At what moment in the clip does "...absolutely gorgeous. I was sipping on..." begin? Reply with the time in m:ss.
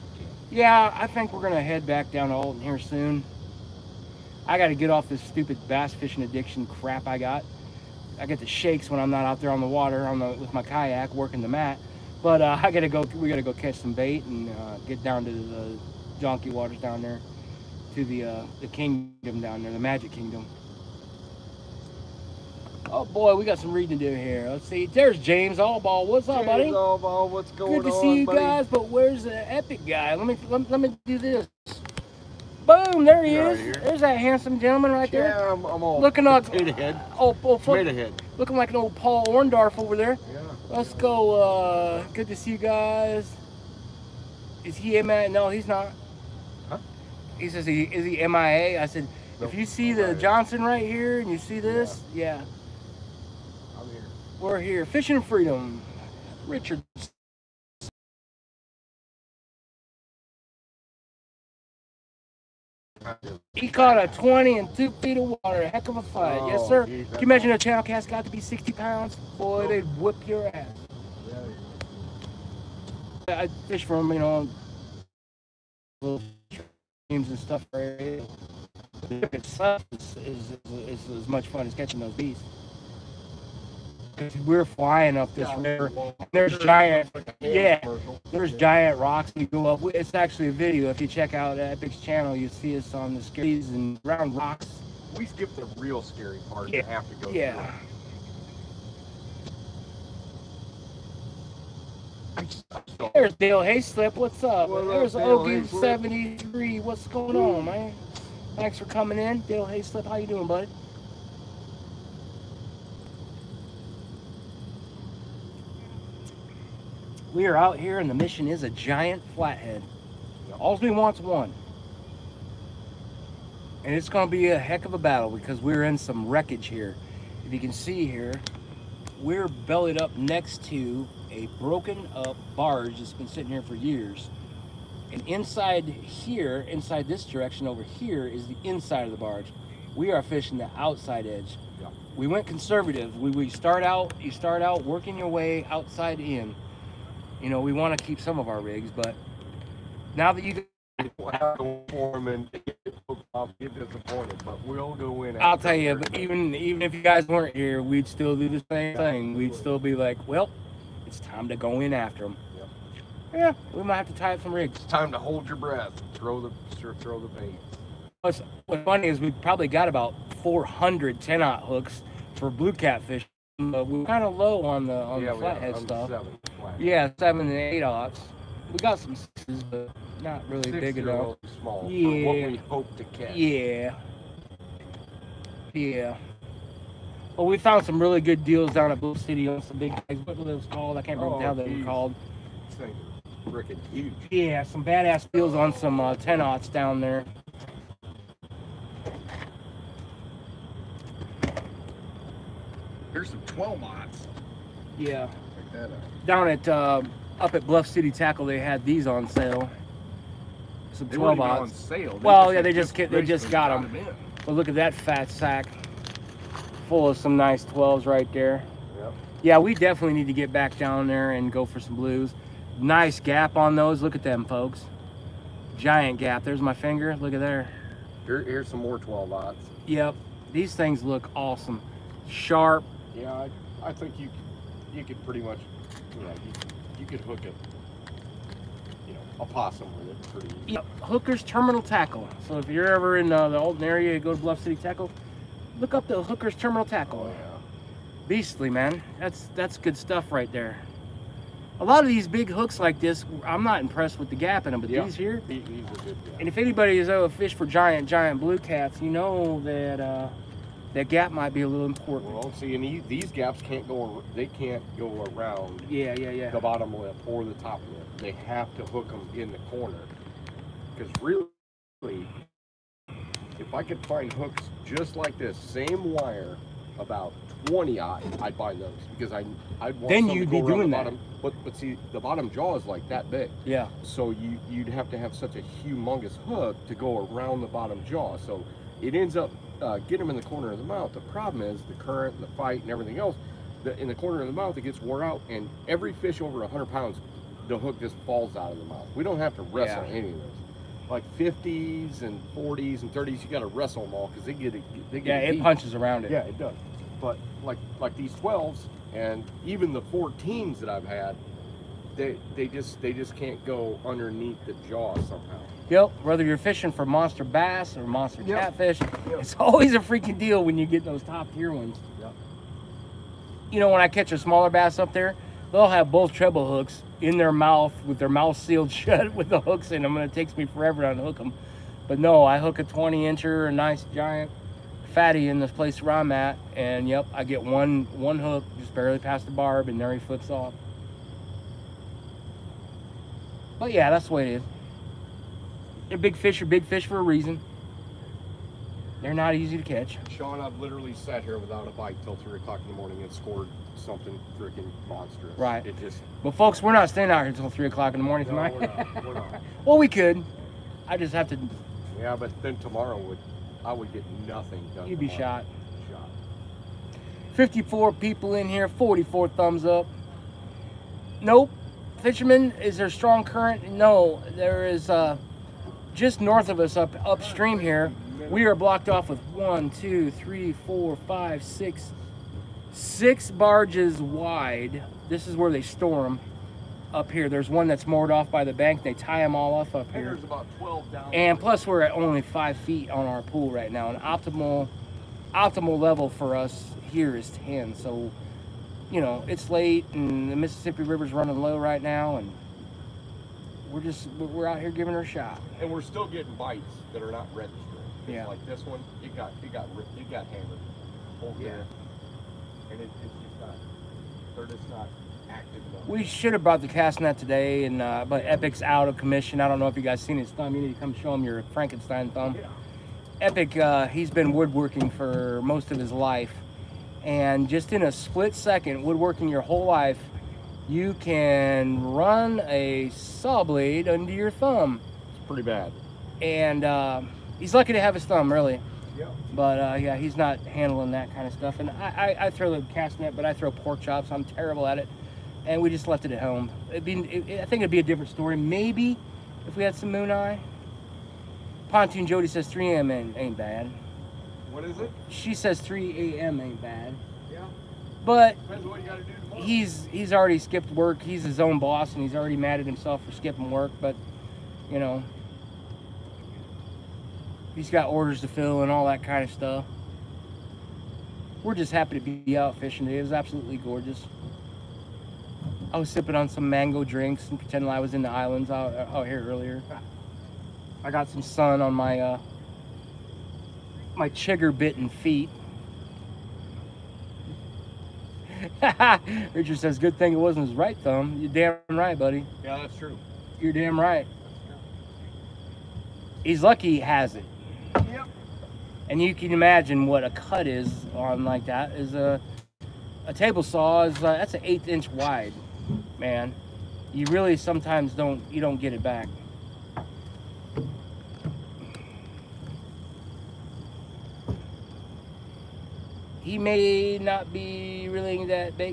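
7:53.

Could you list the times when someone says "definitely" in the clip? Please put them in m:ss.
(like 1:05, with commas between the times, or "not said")
3:39.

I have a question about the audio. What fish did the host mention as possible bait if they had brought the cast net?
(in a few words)
moon eye.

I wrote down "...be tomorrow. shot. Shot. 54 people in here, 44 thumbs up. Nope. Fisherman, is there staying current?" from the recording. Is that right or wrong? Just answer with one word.
wrong.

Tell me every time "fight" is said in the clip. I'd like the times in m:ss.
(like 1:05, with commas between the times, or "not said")
1:06, 4:52.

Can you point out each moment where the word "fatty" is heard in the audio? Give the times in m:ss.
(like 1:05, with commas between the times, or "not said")
5:35.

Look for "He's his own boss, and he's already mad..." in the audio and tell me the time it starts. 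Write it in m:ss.
7:41.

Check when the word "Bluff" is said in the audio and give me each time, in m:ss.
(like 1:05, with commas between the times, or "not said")
3:08, 3:27, 4:04.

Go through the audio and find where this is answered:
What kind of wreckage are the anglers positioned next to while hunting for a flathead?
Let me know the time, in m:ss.
2:11.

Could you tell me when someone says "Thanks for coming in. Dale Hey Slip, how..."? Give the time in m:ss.
1:48.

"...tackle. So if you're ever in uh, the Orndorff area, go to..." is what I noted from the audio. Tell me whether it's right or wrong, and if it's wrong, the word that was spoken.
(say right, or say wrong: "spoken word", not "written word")
wrong: "Alton", not "Orndorff".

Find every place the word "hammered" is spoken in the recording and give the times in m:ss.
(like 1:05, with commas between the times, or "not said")
6:50.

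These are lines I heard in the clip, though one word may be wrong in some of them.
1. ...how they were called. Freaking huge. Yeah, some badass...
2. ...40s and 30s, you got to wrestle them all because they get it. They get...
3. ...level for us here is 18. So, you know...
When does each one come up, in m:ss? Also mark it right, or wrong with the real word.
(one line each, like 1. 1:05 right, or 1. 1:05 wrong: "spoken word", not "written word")
1. 3:11 right
2. 5:02 right
3. 6:35 wrong: "10", not "18".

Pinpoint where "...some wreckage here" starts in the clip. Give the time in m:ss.
2:05.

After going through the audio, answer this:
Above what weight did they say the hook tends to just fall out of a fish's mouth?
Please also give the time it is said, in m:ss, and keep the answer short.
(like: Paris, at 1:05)
100 pounds, at 4:56.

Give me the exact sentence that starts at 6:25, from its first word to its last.
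This is where they store them up here.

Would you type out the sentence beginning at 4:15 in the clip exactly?
These, and if anybody is oh, a fish for giant, giant blue cats, you know that...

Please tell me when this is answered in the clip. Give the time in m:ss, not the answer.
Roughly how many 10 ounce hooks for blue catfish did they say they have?
2:50.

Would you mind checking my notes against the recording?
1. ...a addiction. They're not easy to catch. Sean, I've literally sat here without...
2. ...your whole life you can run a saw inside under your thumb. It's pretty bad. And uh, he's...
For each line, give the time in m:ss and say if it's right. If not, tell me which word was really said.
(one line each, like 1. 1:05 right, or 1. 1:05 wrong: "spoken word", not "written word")
1. 5:47 wrong: "reason", not "addiction"
2. 7:09 wrong: "blade", not "inside".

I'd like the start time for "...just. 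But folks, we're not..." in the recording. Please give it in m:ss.
5:55.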